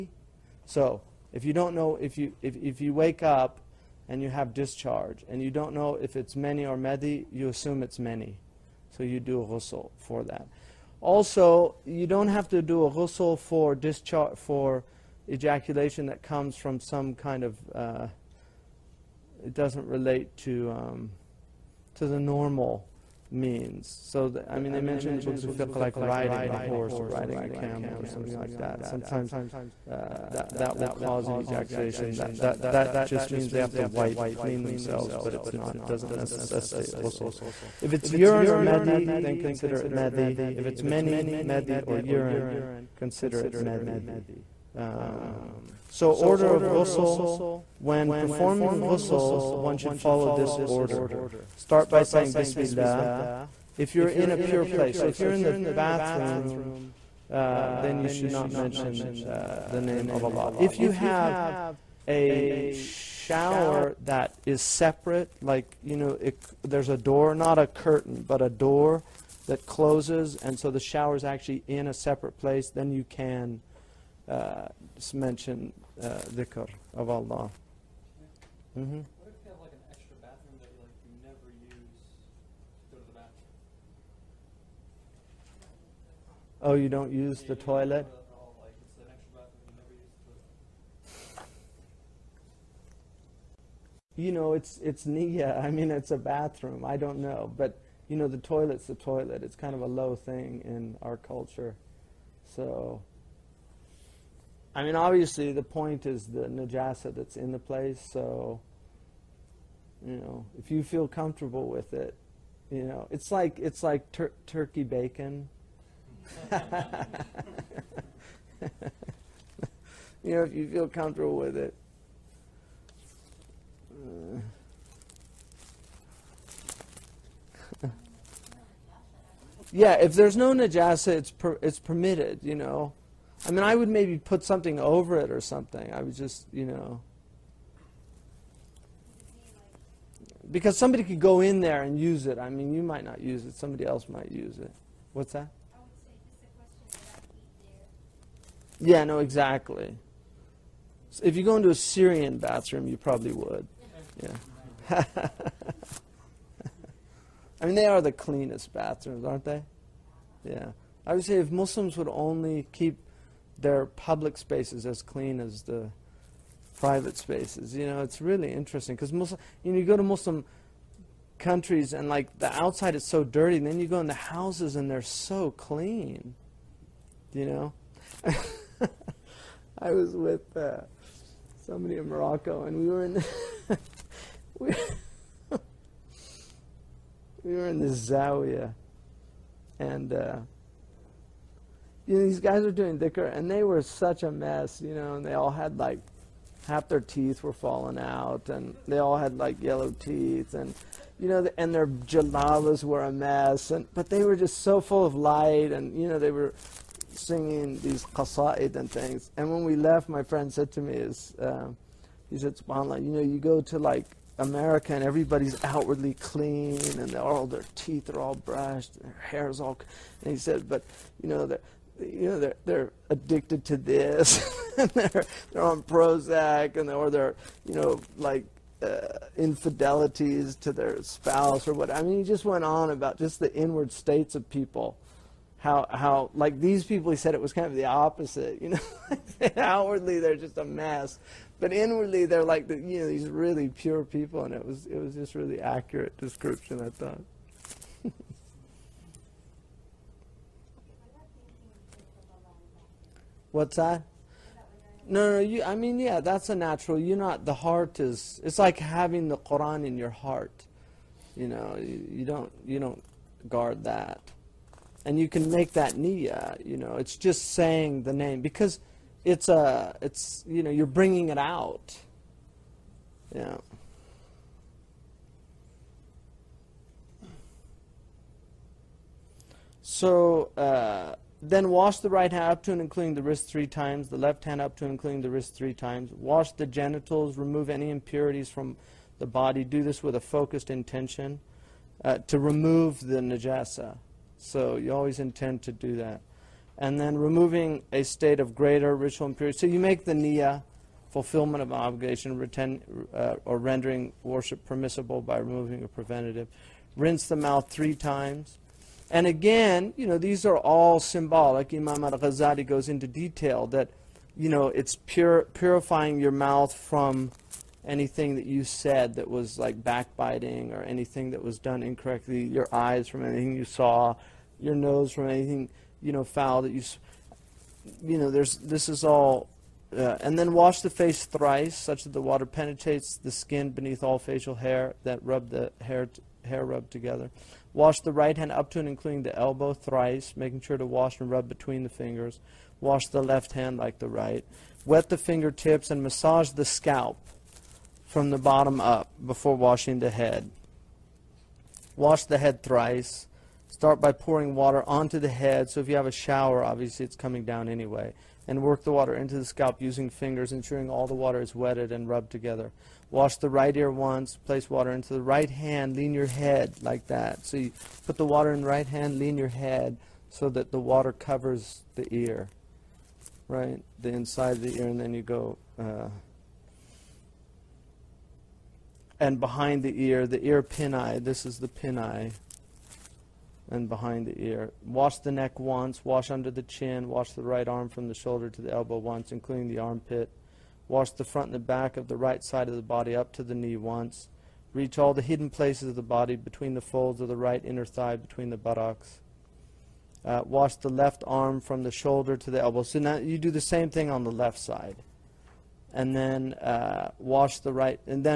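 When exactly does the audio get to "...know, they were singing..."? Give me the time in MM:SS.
03:26.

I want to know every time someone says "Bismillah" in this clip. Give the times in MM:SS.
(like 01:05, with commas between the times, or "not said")
00:52.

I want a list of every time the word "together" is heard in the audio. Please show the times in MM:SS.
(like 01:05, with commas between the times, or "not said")
05:36, 06:02.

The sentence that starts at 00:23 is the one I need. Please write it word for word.
So the, I mean, they mentioned the books of fiqh like riding a horse or riding a camel or something like that.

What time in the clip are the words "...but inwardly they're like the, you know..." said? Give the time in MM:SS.
04:01.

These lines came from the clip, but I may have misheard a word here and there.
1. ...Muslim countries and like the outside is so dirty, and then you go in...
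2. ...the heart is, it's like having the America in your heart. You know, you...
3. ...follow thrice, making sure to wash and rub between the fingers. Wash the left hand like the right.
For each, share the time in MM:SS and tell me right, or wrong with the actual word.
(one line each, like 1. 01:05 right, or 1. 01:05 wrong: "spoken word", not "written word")
1. 02:50 right
2. 04:17 wrong: "Quran", not "America"
3. 05:39 wrong: "elbow", not "follow".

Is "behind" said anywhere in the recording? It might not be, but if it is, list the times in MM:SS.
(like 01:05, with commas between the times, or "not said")
06:19, 06:23.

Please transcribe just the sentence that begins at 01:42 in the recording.
So, I mean, obviously, the point is the najasa that's in the place.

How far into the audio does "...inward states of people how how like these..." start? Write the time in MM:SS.
03:53.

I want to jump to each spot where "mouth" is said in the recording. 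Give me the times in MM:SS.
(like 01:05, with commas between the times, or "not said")
05:07, 05:16.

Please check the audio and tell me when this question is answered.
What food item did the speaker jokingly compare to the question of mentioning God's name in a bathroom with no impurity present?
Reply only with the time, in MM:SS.
01:54.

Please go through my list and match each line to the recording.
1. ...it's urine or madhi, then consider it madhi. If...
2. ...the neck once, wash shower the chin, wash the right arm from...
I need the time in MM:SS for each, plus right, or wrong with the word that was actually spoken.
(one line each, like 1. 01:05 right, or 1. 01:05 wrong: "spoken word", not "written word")
1. 00:37 right
2. 06:25 wrong: "under", not "shower".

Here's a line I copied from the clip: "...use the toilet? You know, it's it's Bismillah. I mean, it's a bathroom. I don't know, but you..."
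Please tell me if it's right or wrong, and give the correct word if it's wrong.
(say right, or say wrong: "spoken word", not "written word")
wrong: "Nia", not "Bismillah".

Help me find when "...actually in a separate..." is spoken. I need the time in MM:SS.
01:11.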